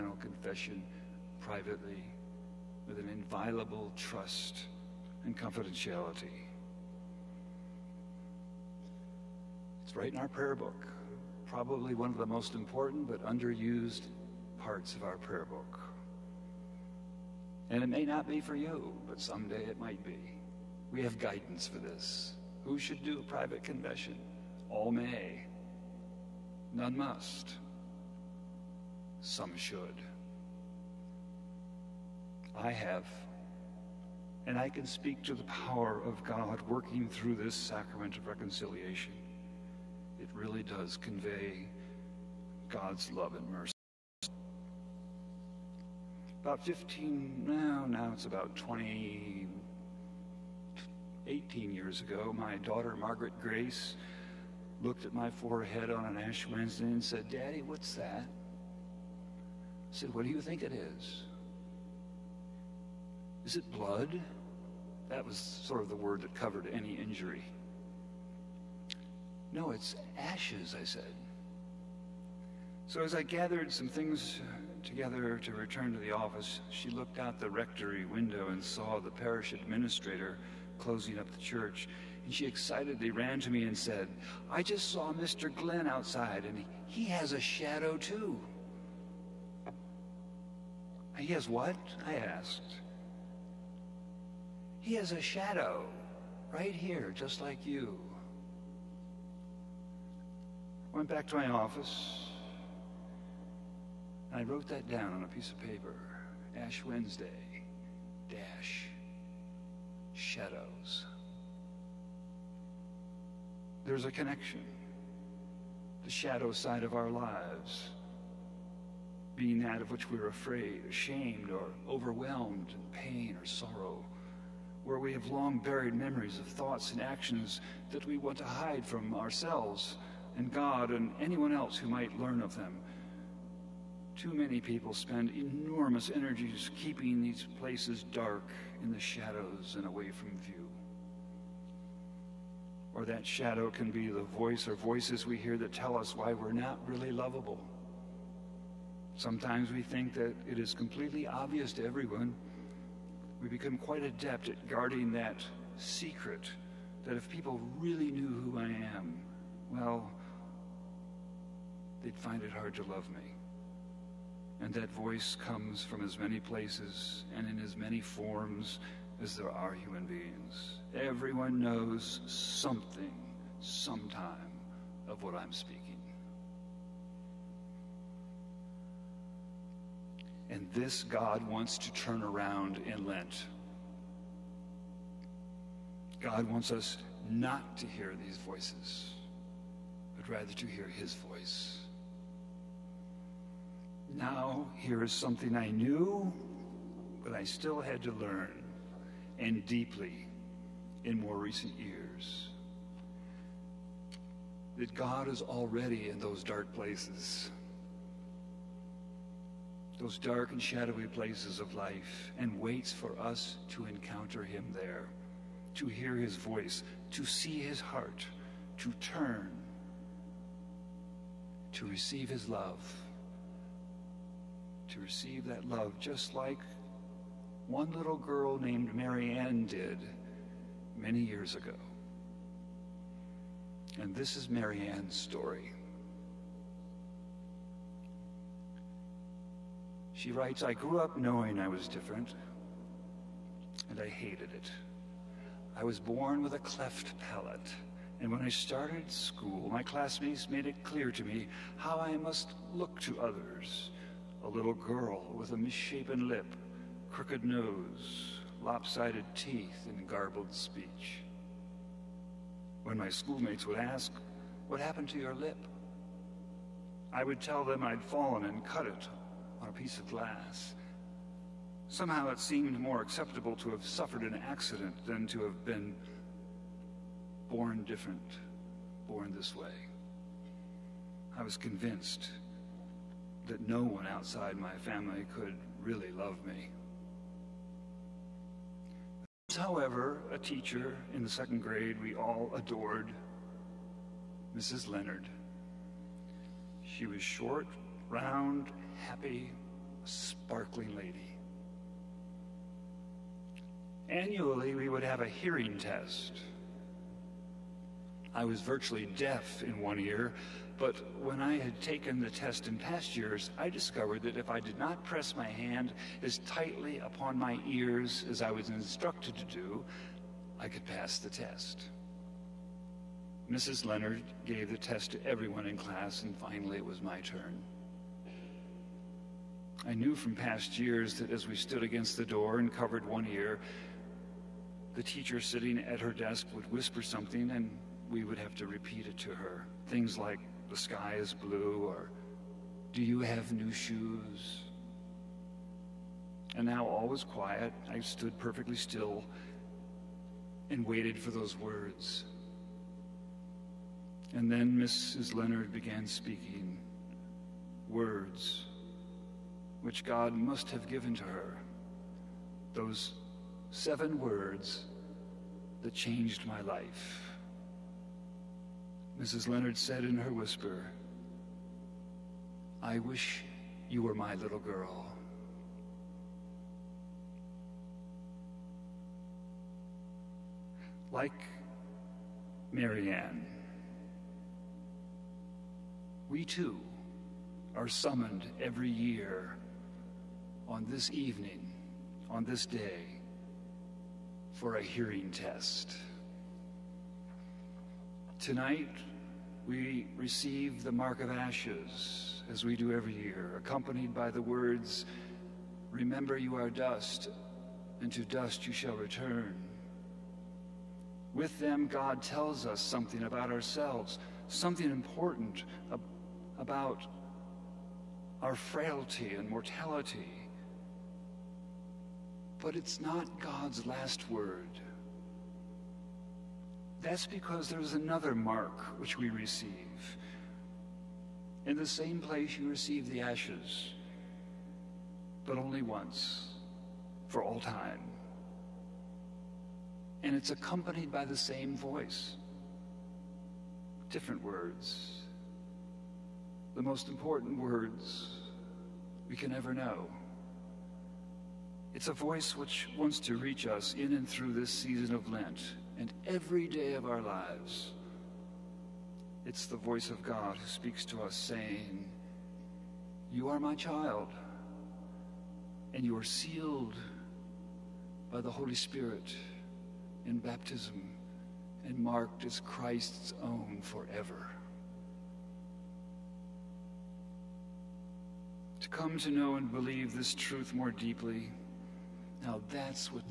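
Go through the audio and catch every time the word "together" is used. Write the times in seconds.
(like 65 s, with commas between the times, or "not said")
74 s.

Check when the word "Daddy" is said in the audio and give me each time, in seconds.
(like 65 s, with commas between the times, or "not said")
57 s.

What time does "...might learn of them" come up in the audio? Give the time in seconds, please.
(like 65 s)
131 s.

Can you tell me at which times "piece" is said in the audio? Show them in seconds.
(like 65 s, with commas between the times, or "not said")
105 s, 269 s.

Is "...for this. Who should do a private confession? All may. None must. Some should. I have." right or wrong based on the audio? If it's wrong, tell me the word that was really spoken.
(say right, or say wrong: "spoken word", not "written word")
right.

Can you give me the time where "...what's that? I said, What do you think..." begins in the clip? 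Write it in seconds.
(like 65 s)
57 s.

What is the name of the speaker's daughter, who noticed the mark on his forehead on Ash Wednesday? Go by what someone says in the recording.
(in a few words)
Margaret Grace.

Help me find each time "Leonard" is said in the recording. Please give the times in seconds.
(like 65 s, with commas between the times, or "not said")
294 s, 323 s, 355 s, 369 s.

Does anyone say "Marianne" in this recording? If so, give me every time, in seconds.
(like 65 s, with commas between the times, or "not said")
228 s, 234 s, 382 s.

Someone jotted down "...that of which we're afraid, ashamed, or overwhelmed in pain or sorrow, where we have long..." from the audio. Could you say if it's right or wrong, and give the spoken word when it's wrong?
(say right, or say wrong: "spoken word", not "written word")
right.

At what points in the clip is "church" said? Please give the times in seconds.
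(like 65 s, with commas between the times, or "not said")
81 s.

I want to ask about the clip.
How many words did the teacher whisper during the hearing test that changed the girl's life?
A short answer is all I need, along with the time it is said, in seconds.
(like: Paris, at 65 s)
7, at 363 s.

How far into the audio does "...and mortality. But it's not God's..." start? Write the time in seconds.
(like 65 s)
419 s.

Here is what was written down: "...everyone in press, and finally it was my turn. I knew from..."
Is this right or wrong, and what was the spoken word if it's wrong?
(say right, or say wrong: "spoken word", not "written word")
wrong: "class", not "press".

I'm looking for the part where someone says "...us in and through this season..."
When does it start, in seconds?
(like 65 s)
453 s.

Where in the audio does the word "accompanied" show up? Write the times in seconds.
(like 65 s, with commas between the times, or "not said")
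403 s, 440 s.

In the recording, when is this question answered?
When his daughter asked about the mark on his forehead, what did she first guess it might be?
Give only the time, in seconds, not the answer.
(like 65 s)
63 s.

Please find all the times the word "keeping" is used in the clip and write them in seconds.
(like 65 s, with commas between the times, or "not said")
136 s.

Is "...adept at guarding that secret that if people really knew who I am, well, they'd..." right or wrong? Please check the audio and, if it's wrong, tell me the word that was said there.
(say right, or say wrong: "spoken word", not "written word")
right.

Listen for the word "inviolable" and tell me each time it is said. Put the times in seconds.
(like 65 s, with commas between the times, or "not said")
3 s.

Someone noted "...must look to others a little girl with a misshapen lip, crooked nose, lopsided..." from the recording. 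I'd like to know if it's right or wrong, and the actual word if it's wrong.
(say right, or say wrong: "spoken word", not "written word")
right.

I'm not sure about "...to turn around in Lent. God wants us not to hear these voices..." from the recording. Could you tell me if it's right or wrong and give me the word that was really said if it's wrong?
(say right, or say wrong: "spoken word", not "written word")
right.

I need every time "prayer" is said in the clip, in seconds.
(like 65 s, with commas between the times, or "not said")
10 s, 15 s.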